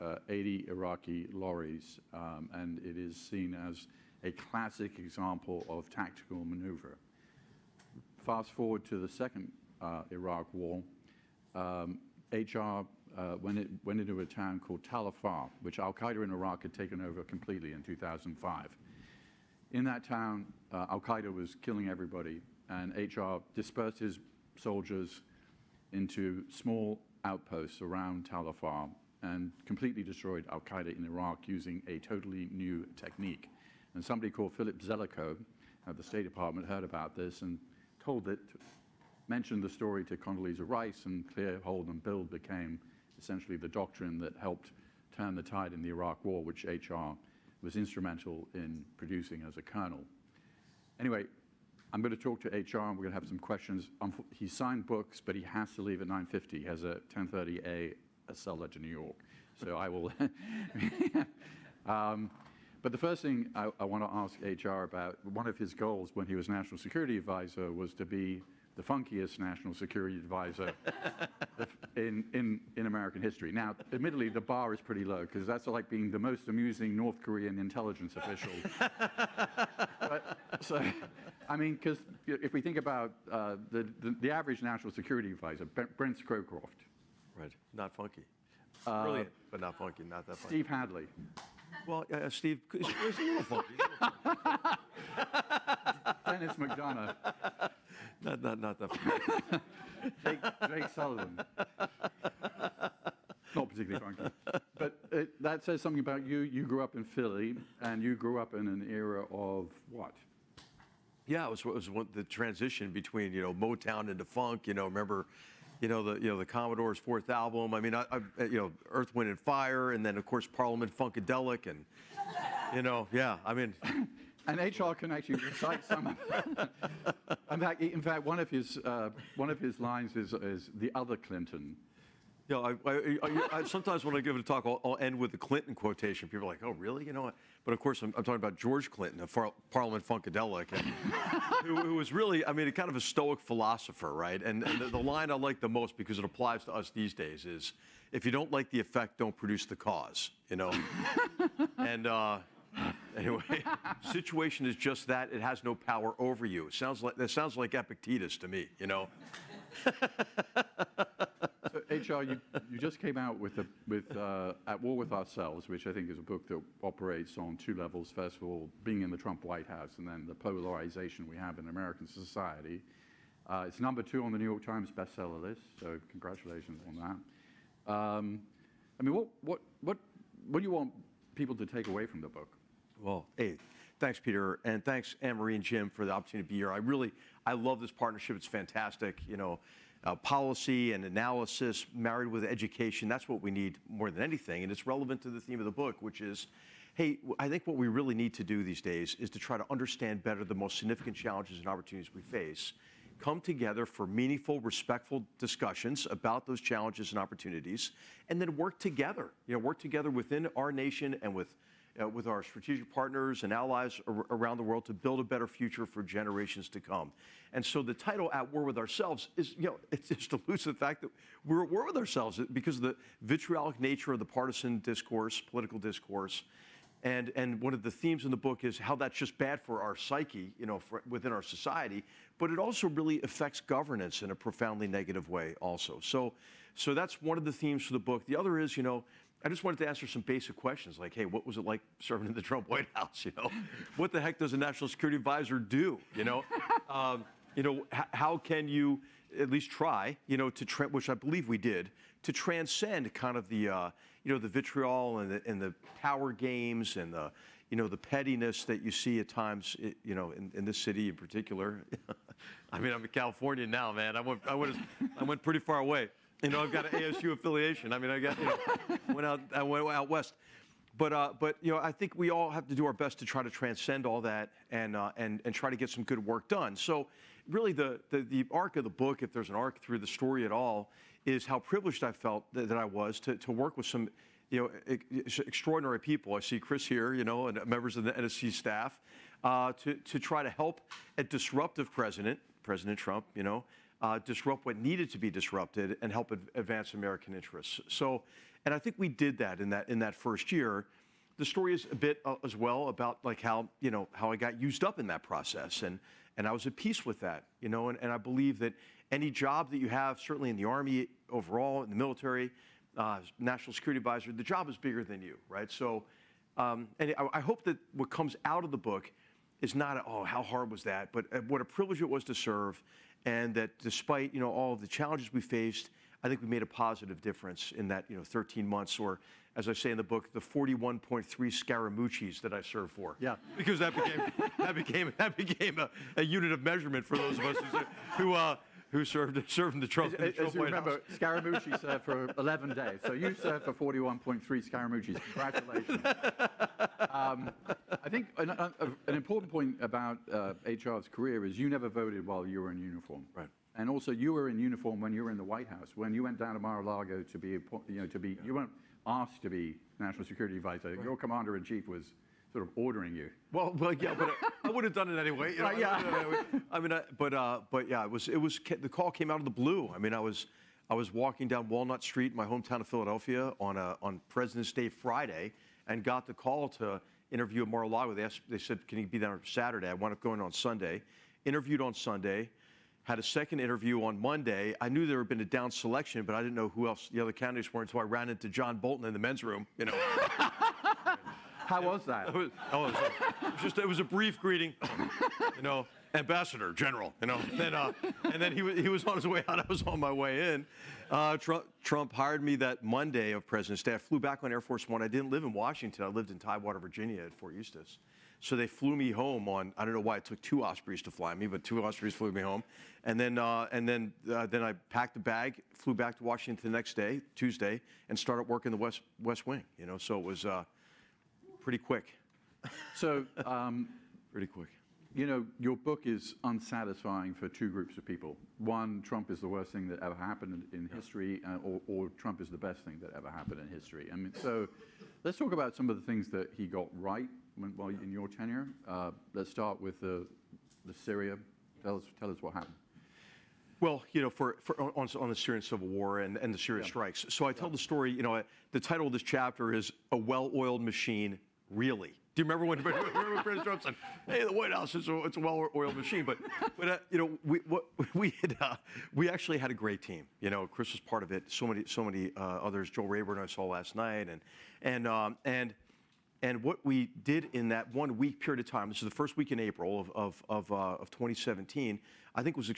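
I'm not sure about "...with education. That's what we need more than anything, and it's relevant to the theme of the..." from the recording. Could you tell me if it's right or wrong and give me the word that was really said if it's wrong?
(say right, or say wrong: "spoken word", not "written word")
right.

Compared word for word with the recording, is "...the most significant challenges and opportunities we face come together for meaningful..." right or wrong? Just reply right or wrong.
right.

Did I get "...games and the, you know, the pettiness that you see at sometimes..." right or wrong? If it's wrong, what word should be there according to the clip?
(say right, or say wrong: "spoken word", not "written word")
wrong: "times", not "sometimes".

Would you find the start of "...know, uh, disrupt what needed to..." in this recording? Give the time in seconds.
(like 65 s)
293 s.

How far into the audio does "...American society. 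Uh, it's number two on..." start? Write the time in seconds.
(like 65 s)
171 s.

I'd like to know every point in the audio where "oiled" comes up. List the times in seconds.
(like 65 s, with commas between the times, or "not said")
450 s, 455 s.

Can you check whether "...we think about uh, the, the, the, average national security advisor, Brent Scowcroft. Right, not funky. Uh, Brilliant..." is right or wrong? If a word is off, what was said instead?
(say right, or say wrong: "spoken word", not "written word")
right.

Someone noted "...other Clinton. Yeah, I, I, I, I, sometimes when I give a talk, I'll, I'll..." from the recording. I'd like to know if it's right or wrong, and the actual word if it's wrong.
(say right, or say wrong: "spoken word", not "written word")
right.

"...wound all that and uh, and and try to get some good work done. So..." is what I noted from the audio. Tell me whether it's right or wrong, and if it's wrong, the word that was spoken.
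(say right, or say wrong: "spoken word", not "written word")
wrong: "transcend", not "wound".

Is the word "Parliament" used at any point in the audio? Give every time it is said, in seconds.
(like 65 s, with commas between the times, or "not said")
120 s, 139 s.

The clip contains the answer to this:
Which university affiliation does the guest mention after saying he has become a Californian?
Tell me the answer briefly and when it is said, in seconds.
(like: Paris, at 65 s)
ASU, at 266 s.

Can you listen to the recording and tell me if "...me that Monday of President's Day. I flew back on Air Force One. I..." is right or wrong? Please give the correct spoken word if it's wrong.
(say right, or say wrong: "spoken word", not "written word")
right.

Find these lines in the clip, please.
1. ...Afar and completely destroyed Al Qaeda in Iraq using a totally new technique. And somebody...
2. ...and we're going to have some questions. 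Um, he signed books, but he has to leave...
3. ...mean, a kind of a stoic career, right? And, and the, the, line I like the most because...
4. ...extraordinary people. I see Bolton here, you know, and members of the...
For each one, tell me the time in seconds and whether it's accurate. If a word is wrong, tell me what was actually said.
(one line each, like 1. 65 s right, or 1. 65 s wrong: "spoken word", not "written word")
1. 28 s right
2. 52 s right
3. 142 s wrong: "philosopher", not "career"
4. 285 s wrong: "Chris", not "Bolton".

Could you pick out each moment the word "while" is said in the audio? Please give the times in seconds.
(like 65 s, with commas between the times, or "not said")
352 s, 437 s.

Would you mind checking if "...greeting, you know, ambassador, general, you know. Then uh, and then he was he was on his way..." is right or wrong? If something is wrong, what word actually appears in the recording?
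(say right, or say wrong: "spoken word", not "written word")
right.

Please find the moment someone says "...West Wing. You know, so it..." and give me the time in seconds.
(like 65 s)
419 s.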